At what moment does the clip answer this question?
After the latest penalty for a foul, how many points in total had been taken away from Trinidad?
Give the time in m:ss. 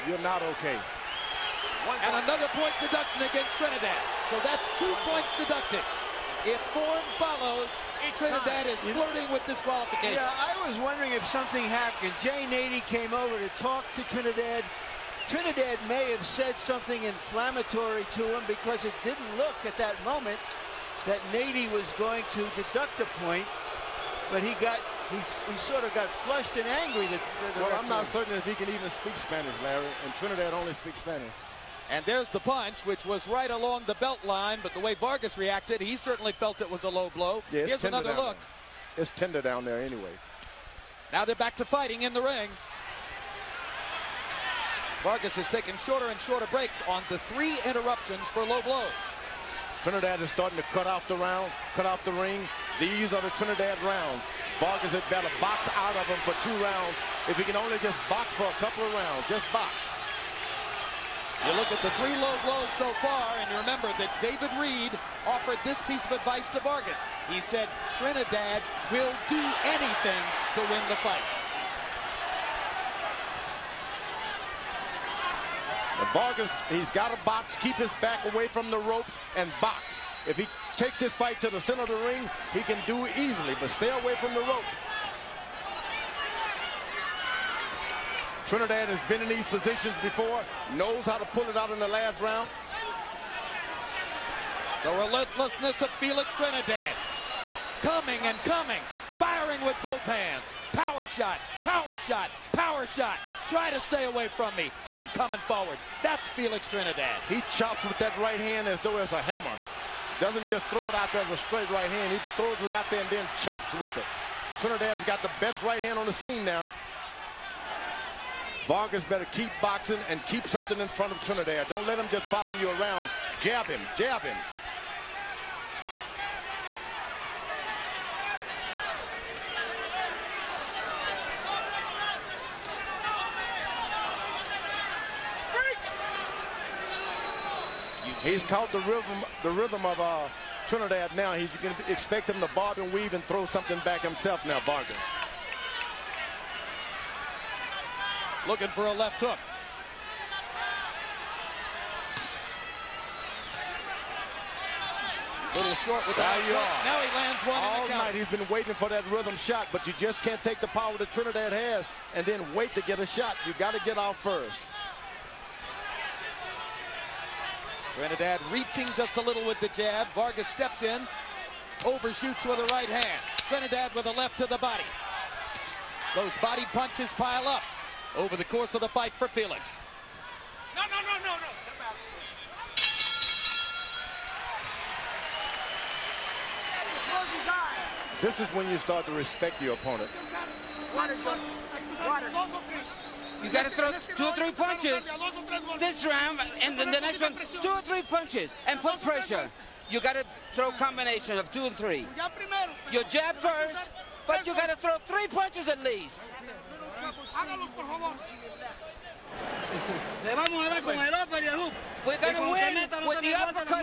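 0:04.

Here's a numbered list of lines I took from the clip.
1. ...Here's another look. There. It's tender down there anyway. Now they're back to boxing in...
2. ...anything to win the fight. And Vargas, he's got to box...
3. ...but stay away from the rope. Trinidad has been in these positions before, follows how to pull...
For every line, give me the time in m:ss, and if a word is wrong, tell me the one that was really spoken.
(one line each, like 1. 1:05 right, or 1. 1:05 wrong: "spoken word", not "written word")
1. 0:37 wrong: "fighting", not "boxing"
2. 1:09 right
3. 1:23 wrong: "knows", not "follows".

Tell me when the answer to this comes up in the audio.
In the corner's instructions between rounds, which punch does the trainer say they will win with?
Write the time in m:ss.
3:33.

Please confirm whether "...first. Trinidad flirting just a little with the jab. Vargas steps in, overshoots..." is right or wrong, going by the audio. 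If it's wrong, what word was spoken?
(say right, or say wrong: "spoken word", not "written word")
wrong: "reaching", not "flirting".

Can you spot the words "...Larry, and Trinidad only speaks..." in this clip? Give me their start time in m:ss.
0:29.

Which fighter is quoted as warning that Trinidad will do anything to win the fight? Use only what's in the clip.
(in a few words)
David Reid.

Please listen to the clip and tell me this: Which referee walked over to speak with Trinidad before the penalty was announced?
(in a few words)
Jay Nady.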